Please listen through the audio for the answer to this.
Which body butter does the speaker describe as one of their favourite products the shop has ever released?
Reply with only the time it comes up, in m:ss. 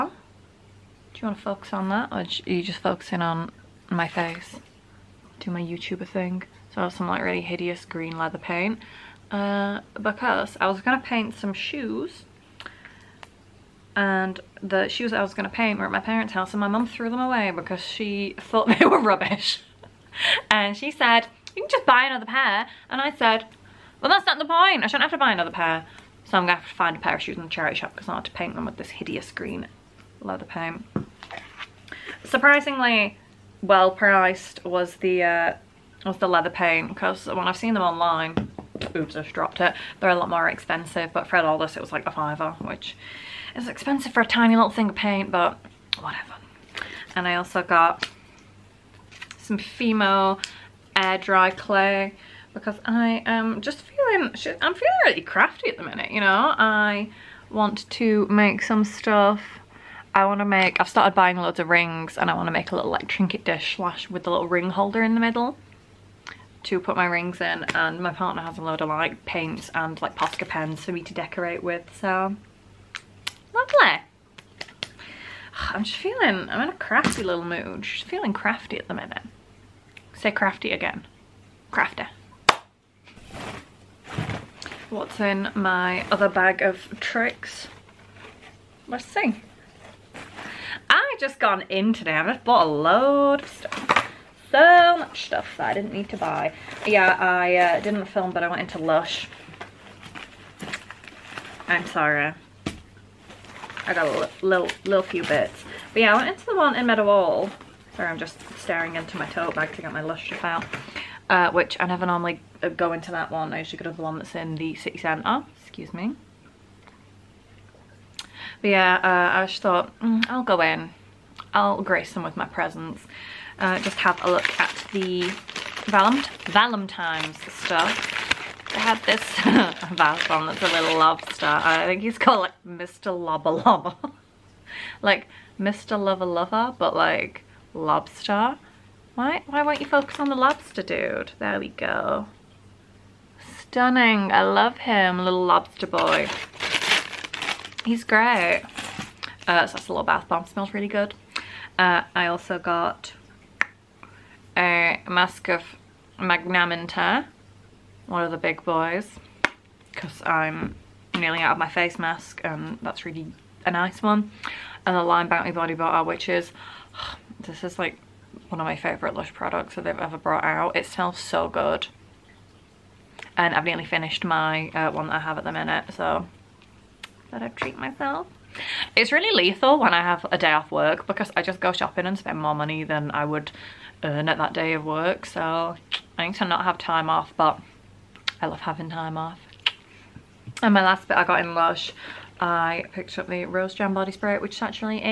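2:45.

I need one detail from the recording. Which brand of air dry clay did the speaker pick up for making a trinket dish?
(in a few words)
Fimo.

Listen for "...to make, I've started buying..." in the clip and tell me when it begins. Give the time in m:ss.
1:00.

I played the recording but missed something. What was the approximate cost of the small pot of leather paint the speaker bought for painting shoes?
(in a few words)
a fiver.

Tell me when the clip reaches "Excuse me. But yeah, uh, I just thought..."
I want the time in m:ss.
1:55.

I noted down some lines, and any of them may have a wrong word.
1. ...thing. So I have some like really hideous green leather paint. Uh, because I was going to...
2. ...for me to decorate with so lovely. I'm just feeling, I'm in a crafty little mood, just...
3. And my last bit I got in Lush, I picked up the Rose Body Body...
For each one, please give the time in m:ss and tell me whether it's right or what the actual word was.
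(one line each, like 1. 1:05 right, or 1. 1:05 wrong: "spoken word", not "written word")
1. 0:06 right
2. 1:10 right
3. 3:10 wrong: "Jam", not "Body".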